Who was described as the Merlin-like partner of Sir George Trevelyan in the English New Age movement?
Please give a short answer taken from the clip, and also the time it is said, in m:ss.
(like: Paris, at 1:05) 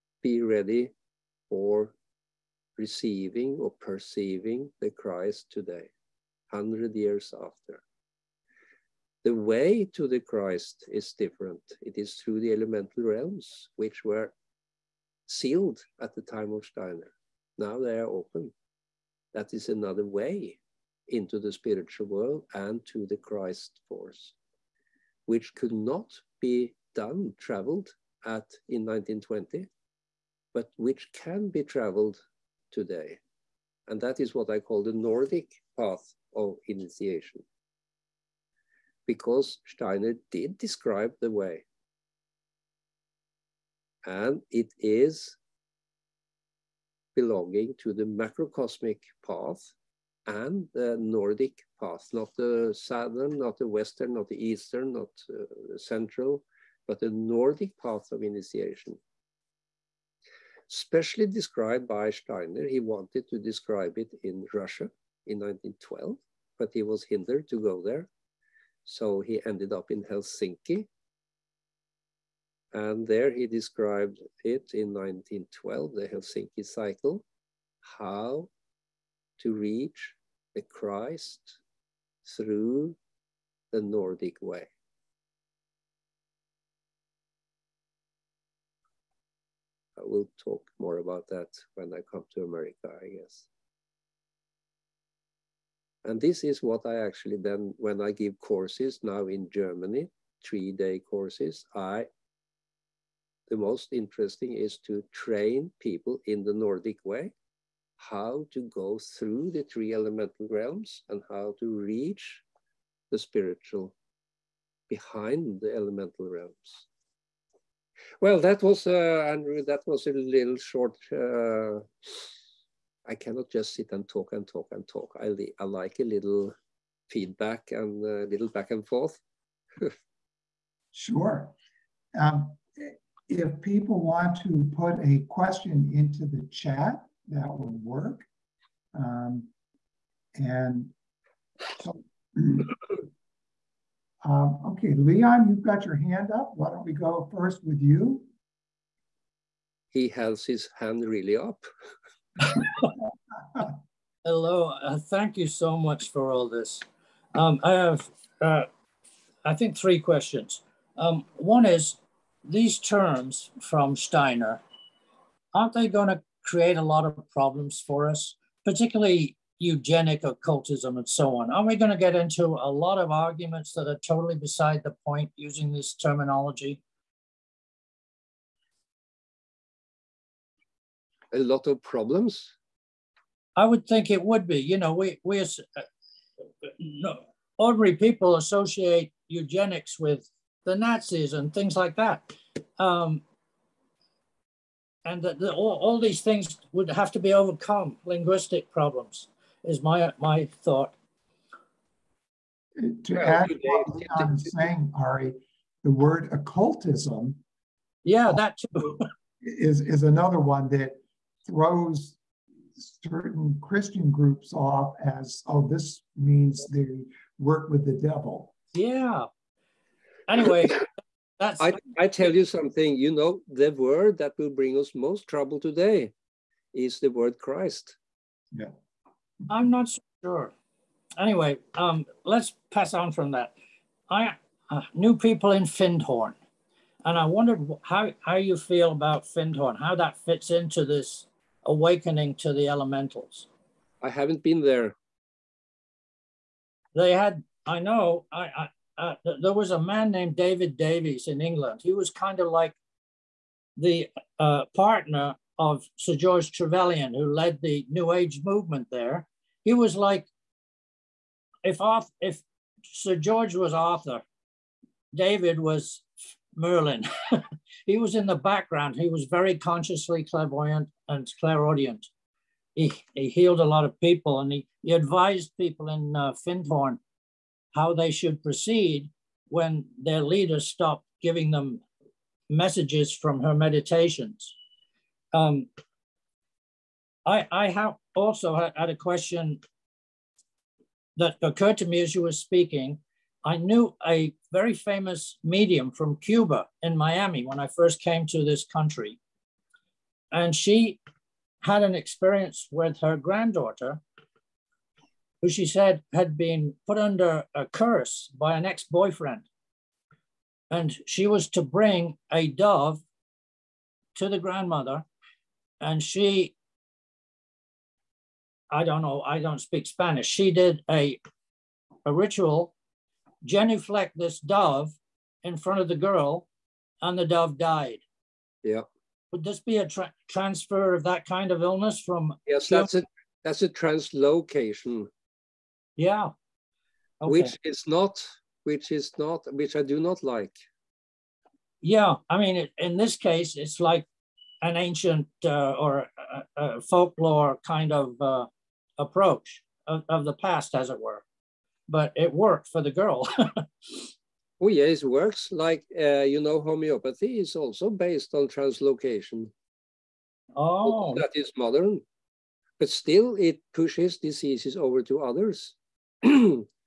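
David Davies, at 4:10.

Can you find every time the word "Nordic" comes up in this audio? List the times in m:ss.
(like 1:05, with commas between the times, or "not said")
0:34, 0:50, 0:57, 1:23, 1:46.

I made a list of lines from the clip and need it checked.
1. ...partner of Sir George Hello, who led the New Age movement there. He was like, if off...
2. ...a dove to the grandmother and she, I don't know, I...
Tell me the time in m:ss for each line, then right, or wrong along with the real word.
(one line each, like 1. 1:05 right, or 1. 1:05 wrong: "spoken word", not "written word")
1. 4:14 wrong: "Trevelyan", not "Hello"
2. 5:12 right.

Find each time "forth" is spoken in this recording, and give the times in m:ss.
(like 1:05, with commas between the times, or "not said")
2:08.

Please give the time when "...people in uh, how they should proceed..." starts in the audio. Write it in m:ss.
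4:35.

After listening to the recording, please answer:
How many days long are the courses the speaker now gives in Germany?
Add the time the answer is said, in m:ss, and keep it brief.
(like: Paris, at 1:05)
3, at 1:40.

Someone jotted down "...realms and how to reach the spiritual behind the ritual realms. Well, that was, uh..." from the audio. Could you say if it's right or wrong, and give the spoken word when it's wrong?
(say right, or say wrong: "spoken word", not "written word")
wrong: "elemental", not "ritual".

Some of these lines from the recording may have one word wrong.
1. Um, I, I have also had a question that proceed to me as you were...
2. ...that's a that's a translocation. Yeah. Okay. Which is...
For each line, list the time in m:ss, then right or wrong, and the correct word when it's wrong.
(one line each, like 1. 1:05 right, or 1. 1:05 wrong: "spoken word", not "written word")
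1. 4:45 wrong: "occurred", not "proceed"
2. 5:32 right.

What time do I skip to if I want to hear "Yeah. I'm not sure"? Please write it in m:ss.
3:48.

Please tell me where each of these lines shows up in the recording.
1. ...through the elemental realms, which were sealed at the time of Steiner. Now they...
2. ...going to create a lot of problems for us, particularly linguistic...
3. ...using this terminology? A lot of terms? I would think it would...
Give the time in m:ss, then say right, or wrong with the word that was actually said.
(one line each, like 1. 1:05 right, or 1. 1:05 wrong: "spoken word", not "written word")
1. 0:12 right
2. 2:45 wrong: "eugenic", not "linguistic"
3. 2:55 wrong: "problems", not "terms".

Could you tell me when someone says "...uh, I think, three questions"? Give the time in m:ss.
2:38.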